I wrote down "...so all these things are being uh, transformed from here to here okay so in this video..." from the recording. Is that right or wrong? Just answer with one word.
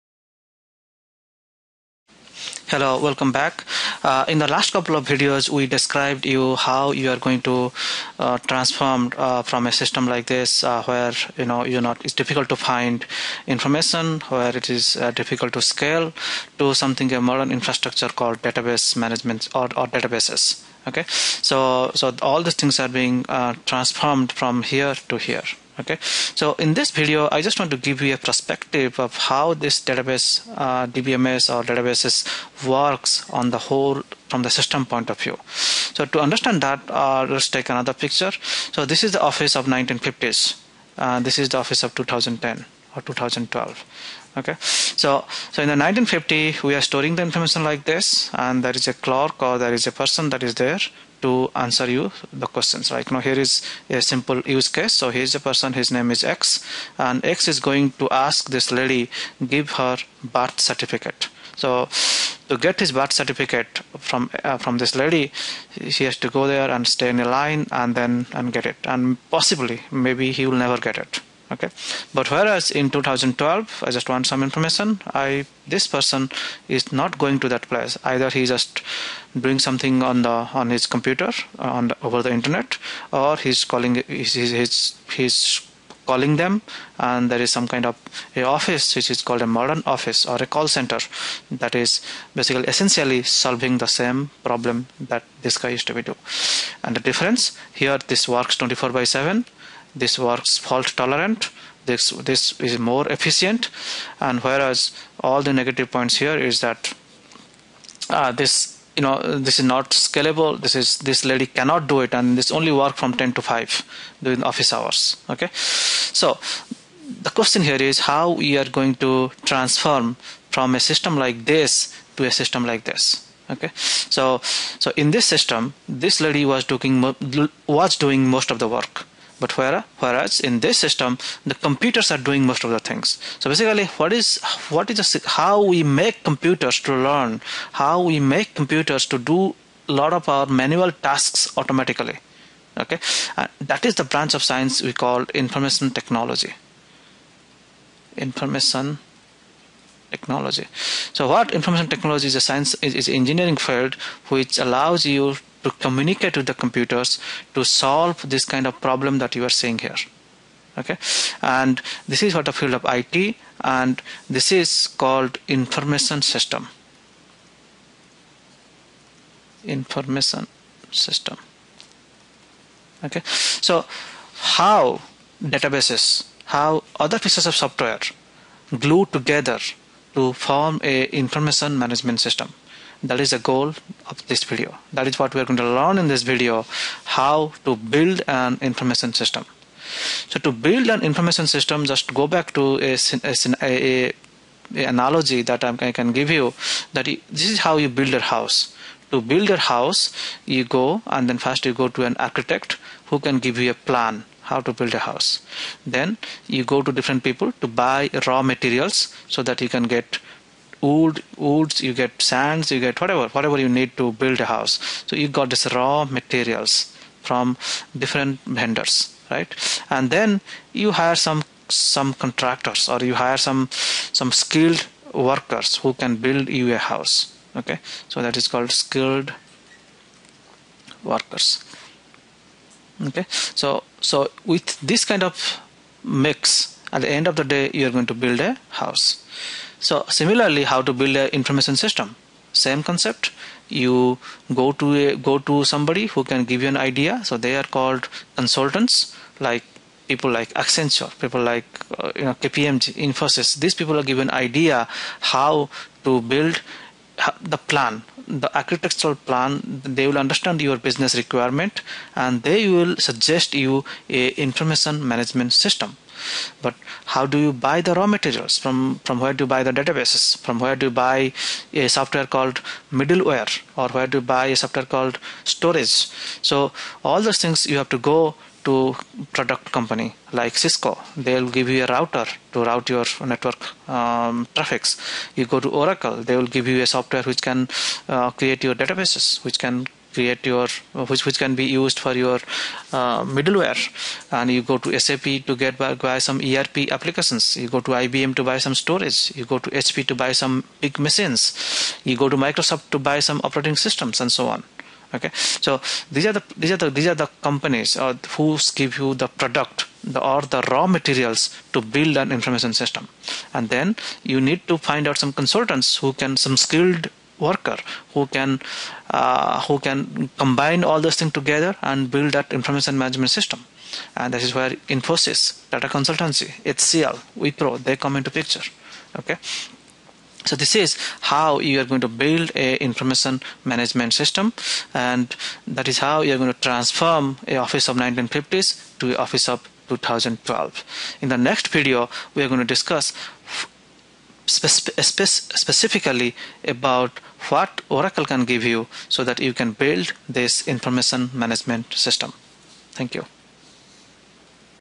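right.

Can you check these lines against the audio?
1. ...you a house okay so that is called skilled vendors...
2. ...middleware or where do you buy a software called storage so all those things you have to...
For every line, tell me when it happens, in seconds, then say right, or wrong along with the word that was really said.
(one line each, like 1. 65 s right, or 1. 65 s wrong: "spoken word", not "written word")
1. 226 s wrong: "workers", not "vendors"
2. 272 s right.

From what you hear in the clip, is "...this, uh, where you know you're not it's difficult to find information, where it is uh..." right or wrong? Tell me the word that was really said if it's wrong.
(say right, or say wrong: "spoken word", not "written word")
right.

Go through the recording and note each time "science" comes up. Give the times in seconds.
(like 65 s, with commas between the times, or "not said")
144 s, 152 s.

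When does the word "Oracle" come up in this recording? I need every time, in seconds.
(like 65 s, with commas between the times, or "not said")
285 s, 347 s.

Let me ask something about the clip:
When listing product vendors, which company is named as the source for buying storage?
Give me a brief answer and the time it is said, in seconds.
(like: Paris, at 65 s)
IBM, at 297 s.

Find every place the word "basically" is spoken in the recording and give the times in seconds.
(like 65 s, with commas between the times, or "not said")
92 s, 133 s.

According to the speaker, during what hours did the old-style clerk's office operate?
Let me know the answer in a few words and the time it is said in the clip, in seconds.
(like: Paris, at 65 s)
10 to 5, at 113 s.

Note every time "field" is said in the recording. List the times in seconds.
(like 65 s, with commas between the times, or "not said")
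153 s, 162 s.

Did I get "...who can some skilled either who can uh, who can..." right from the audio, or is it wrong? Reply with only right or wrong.
wrong.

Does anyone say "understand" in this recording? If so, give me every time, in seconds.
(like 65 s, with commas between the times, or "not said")
36 s, 260 s.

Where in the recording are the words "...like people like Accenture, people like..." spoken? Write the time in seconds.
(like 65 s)
249 s.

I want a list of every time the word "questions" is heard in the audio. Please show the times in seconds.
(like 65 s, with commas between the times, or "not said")
52 s, 117 s.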